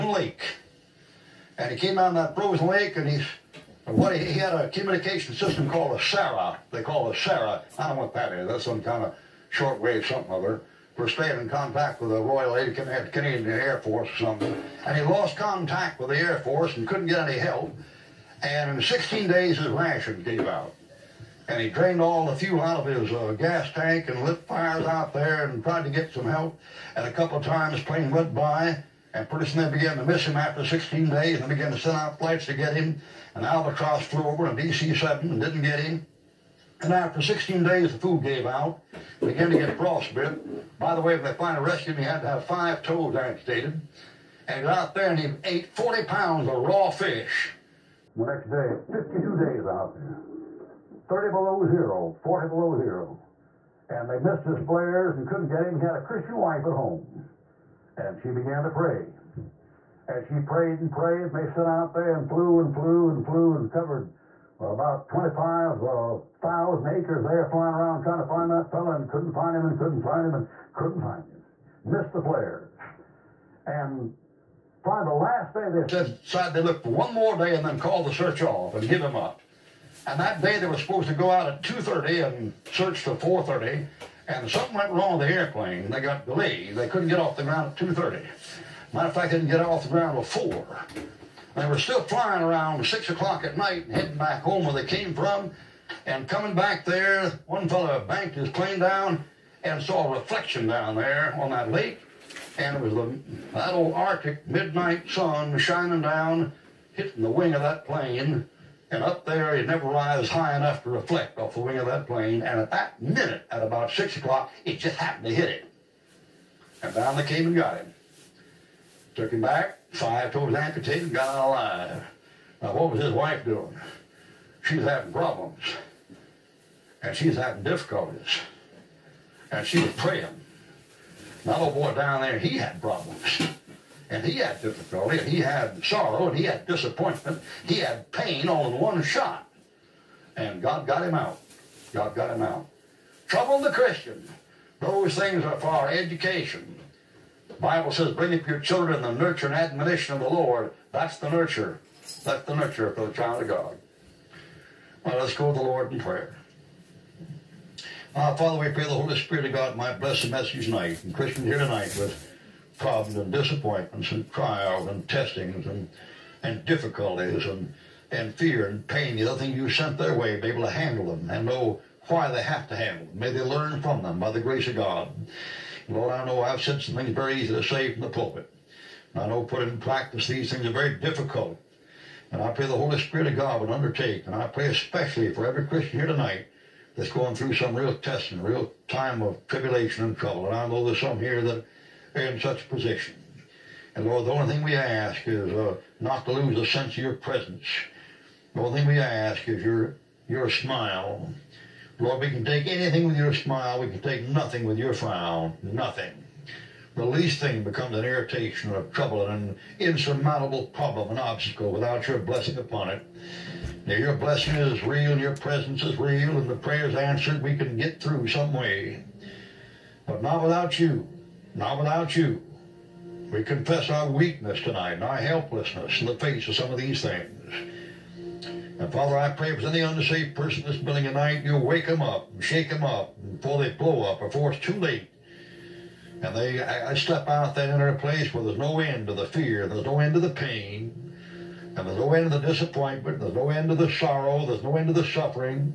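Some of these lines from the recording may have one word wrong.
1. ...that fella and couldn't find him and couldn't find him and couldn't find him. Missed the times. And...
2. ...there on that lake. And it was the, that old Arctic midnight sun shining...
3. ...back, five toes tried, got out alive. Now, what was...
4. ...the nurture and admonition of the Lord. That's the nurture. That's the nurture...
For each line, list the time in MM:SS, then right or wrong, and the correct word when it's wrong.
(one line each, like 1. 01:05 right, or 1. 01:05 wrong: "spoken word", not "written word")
1. 01:08 wrong: "flares", not "times"
2. 01:40 right
3. 01:59 wrong: "amputated", not "tried"
4. 02:29 right.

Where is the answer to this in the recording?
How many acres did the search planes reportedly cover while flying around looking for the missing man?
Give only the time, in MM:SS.
01:05.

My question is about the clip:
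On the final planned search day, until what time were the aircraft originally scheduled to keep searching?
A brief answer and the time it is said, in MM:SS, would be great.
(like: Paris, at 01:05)
4:30, at 01:23.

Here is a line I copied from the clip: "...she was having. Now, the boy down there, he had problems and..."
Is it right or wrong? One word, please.
wrong.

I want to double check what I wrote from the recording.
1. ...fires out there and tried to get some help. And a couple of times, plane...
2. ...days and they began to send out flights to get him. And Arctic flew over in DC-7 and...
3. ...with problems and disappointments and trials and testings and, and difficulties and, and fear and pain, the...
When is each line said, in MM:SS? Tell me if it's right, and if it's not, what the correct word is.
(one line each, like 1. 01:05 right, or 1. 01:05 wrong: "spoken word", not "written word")
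1. 00:24 right
2. 00:31 wrong: "Albatross", not "Arctic"
3. 02:41 right.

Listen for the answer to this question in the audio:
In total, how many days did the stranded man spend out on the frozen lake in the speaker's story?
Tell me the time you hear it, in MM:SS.
00:48.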